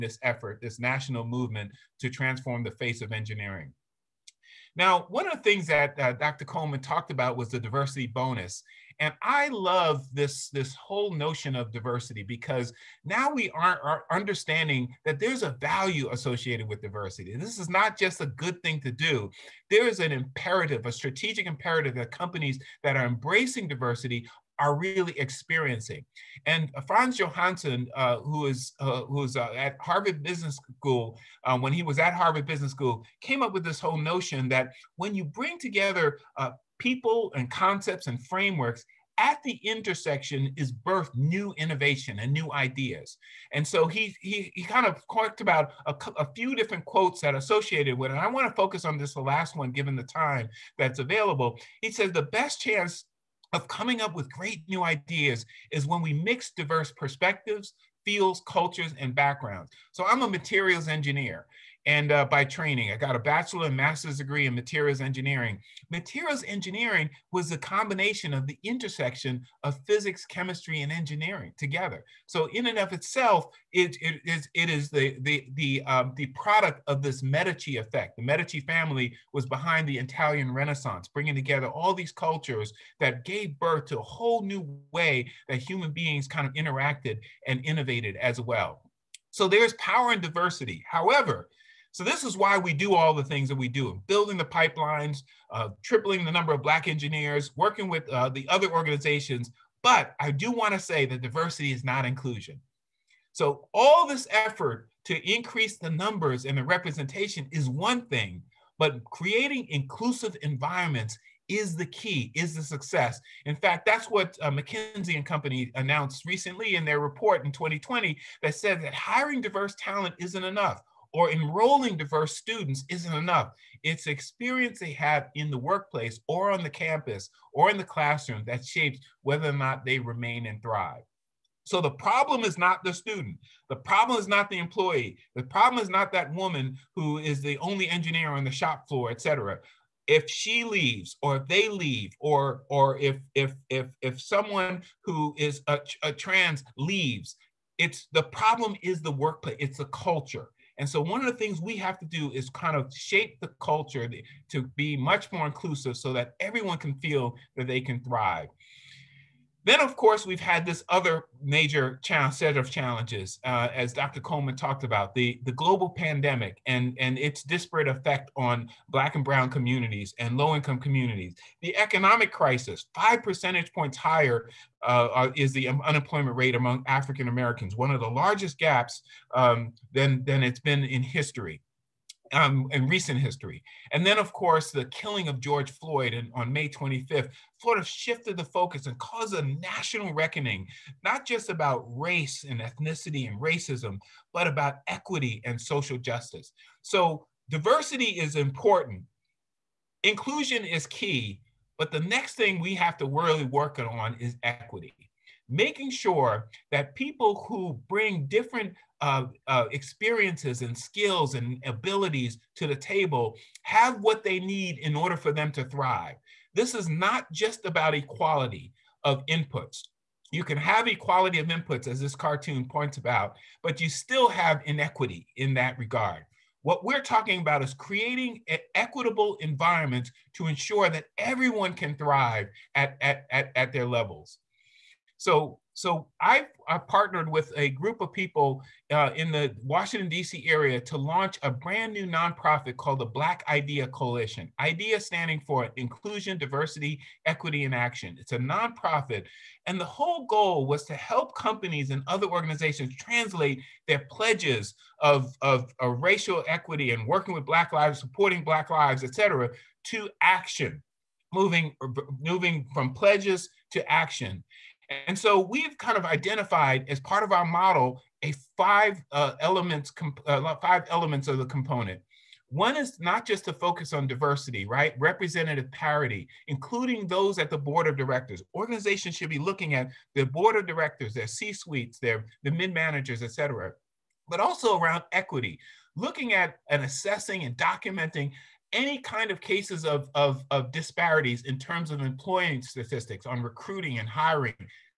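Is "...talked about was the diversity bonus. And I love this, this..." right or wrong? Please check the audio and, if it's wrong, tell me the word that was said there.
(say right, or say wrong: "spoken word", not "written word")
right.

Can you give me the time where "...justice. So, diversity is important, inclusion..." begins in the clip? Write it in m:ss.
3:15.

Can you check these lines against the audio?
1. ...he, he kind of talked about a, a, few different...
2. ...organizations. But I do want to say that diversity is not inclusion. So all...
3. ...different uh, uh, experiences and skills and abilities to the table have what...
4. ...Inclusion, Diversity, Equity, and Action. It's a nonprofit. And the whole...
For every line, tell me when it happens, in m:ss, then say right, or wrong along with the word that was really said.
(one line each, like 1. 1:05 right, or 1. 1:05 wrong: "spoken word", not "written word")
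1. 0:44 right
2. 1:38 right
3. 3:28 right
4. 4:05 right.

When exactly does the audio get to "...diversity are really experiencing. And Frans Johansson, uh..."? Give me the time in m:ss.
0:23.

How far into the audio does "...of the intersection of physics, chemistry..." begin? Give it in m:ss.
1:08.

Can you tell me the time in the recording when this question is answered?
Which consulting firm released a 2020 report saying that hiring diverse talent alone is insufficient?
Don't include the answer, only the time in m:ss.
1:54.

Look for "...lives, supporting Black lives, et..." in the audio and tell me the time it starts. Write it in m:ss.
4:17.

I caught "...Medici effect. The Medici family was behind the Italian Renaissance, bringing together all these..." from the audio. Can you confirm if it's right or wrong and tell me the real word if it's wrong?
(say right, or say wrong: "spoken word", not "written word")
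right.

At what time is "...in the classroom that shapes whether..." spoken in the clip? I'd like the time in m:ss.
2:07.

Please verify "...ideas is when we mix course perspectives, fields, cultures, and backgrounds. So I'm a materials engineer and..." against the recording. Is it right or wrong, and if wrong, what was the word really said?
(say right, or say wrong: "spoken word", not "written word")
wrong: "diverse", not "course".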